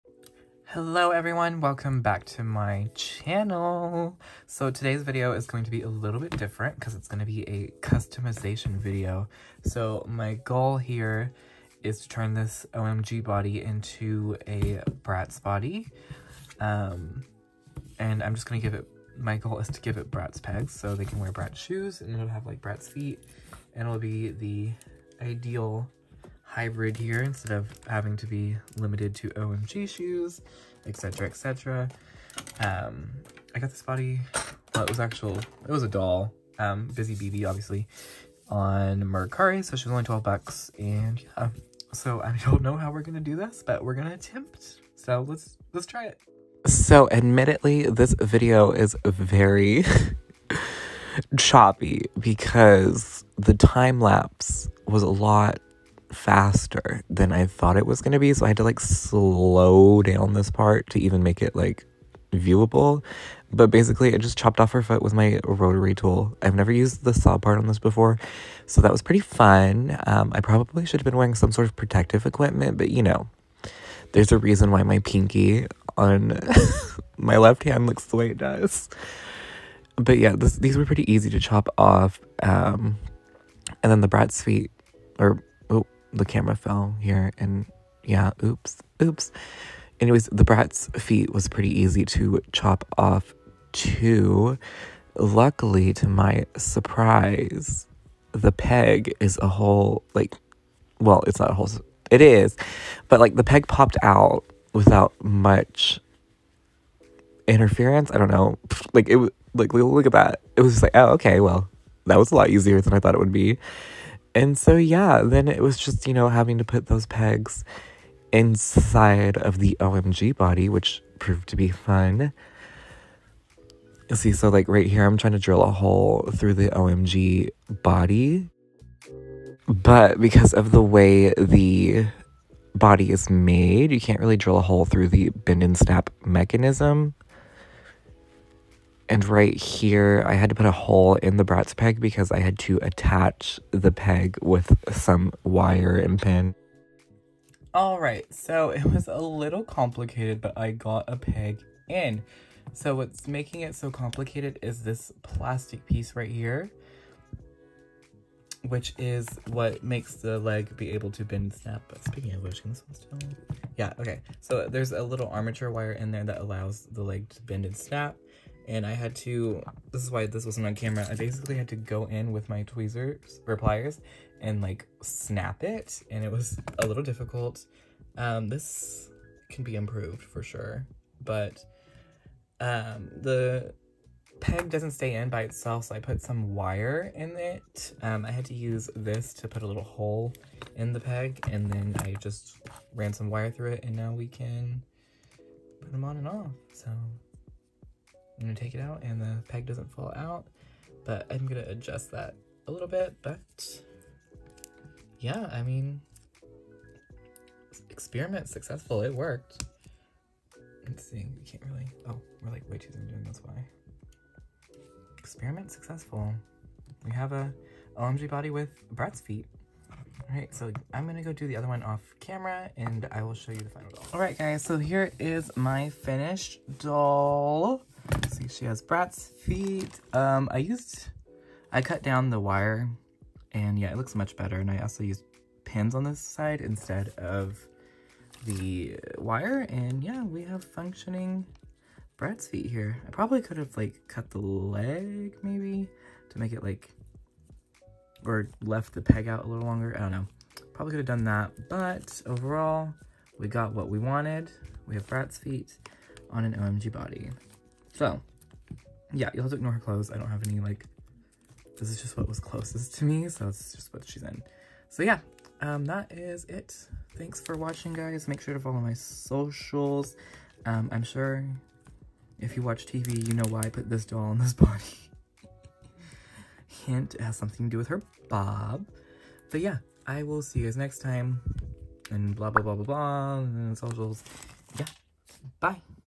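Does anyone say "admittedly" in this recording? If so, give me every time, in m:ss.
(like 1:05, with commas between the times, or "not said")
0:47.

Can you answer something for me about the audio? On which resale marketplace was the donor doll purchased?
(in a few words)
Mercari.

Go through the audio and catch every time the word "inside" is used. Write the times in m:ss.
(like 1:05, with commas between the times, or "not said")
1:58.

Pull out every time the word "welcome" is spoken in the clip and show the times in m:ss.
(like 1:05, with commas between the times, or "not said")
0:01.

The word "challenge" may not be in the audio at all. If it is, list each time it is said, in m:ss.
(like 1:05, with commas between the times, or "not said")
not said.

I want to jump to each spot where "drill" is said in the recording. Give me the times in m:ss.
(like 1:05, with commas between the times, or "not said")
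2:05, 2:14.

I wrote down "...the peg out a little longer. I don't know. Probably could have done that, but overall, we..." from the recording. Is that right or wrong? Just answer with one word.
right.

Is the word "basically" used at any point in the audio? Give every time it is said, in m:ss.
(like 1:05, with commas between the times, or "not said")
1:03, 2:51.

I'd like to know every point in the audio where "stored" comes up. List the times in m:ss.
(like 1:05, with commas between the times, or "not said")
not said.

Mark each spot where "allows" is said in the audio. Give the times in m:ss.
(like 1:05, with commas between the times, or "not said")
2:46.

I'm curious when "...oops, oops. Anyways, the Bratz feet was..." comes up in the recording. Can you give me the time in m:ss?
1:28.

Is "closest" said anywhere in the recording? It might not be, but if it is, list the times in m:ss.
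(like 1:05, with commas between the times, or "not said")
4:22.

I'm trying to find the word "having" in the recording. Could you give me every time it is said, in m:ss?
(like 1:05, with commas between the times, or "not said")
0:27, 1:56.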